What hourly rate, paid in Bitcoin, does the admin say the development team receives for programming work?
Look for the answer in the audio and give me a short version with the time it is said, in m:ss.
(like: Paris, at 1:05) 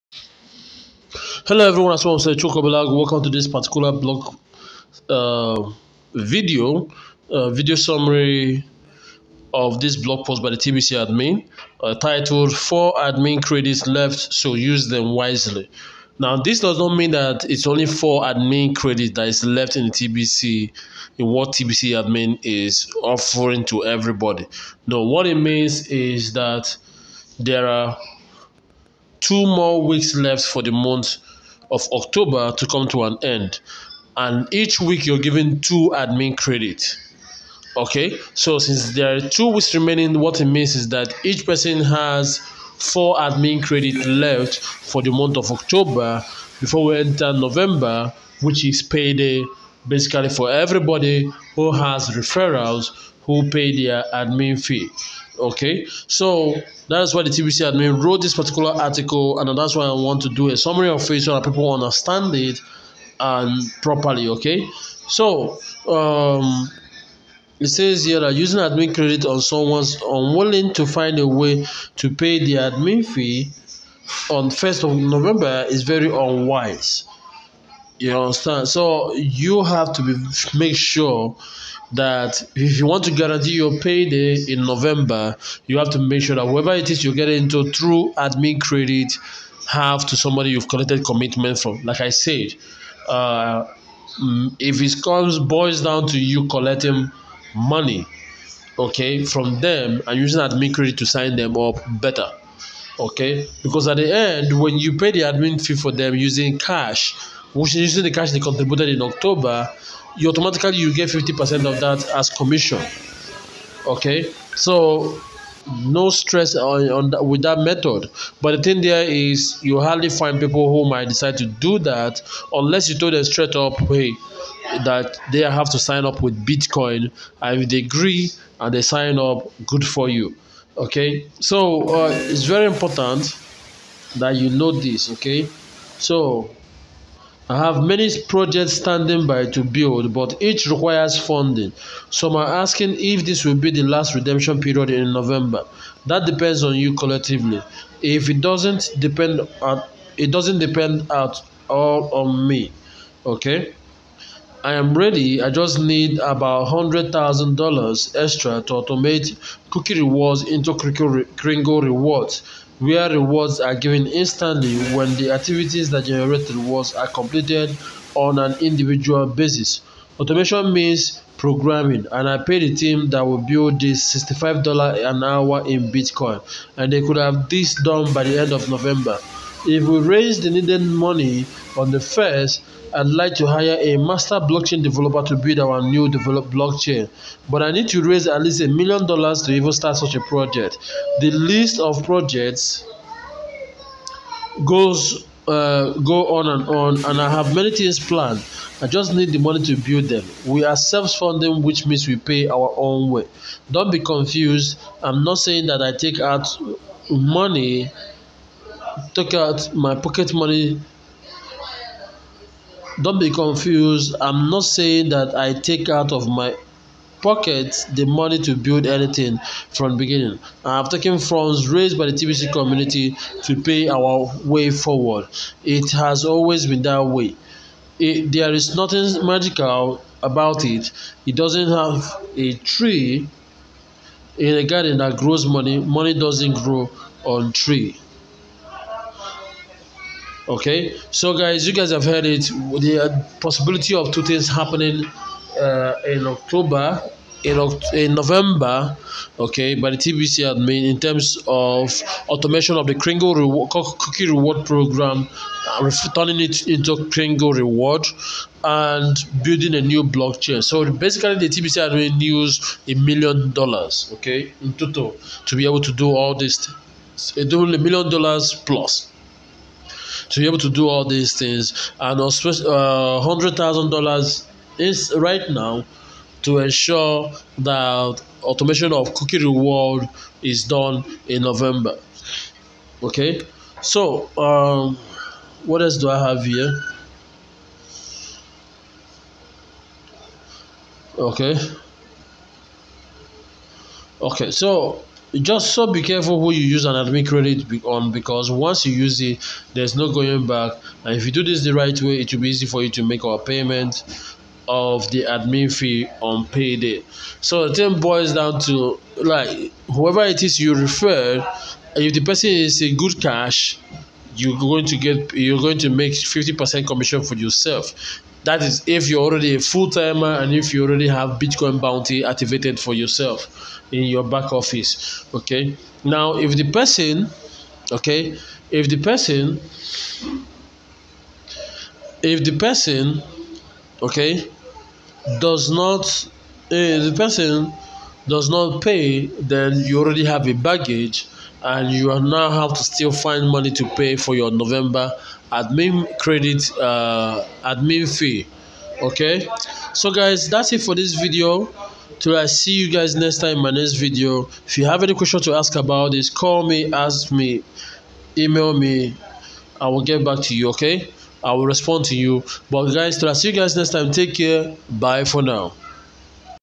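$65, at 2:54.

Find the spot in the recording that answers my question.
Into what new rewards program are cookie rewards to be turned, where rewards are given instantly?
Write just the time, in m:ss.
2:40.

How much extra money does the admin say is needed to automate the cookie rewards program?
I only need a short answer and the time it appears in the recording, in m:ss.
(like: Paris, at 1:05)
$100,000, at 2:36.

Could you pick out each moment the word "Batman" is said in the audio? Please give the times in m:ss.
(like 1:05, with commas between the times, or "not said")
not said.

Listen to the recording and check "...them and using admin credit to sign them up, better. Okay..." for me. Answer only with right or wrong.
right.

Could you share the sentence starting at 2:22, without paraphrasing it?
Some are asking if this will be the last redemption period in November.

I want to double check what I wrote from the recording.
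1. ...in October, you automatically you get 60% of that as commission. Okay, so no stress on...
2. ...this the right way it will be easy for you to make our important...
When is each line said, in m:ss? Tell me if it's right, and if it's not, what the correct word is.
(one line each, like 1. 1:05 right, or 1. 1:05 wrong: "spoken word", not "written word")
1. 1:48 wrong: "50", not "60"
2. 5:01 wrong: "payment", not "important".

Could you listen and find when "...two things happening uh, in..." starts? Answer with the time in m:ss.
4:04.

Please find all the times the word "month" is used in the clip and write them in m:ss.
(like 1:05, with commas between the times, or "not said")
0:30, 0:45.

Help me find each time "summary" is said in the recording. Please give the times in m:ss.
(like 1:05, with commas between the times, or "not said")
0:07, 1:00.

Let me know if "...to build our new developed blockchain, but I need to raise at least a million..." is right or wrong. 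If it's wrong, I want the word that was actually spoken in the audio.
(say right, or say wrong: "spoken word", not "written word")
right.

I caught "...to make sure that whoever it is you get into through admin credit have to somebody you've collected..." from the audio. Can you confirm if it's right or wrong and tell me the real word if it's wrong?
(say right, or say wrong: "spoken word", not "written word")
right.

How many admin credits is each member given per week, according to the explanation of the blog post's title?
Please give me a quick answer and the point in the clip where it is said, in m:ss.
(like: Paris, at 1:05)
2, at 0:35.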